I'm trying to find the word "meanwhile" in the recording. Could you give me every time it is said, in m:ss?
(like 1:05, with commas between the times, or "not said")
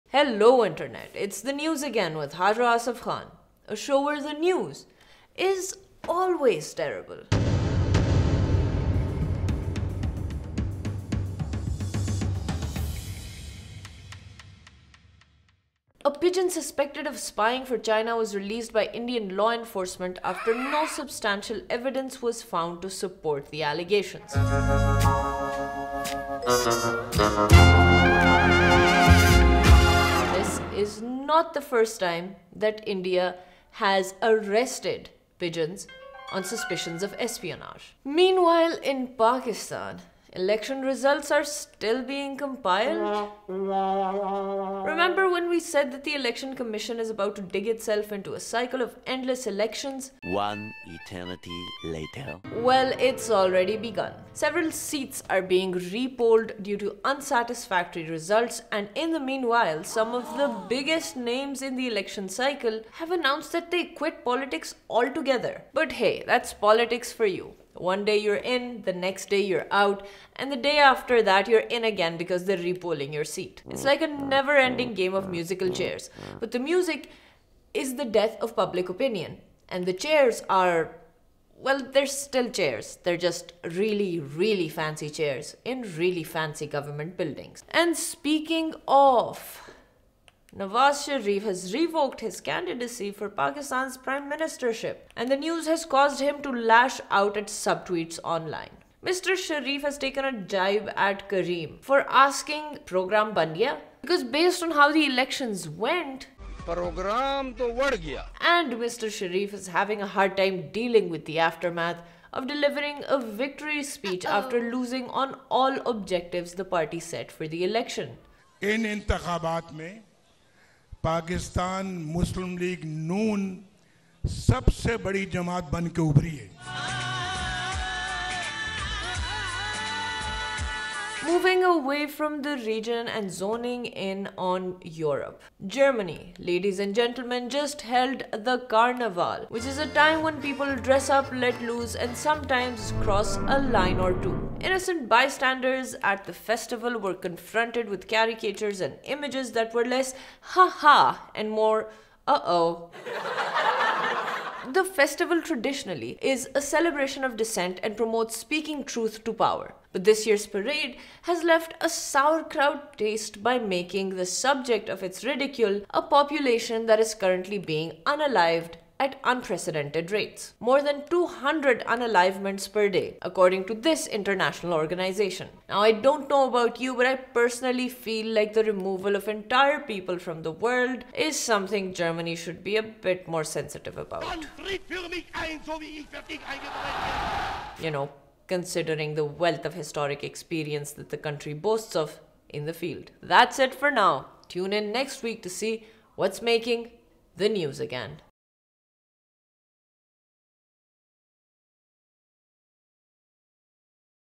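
0:38, 0:59.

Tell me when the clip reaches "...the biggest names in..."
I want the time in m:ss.
1:00.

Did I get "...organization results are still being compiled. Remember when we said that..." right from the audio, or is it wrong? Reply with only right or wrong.
wrong.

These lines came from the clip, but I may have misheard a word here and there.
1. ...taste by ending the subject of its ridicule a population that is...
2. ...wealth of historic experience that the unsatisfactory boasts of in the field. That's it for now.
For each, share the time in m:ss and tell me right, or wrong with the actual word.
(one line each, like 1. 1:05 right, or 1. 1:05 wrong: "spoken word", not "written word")
1. 2:42 wrong: "making", not "ending"
2. 3:09 wrong: "country", not "unsatisfactory".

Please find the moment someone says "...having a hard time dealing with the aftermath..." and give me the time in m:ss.
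1:49.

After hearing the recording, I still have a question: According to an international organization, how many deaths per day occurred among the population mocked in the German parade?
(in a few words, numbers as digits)
More than 200.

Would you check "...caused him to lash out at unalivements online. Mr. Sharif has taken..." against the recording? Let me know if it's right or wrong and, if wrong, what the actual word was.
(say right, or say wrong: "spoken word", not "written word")
wrong: "subtweets", not "unalivements".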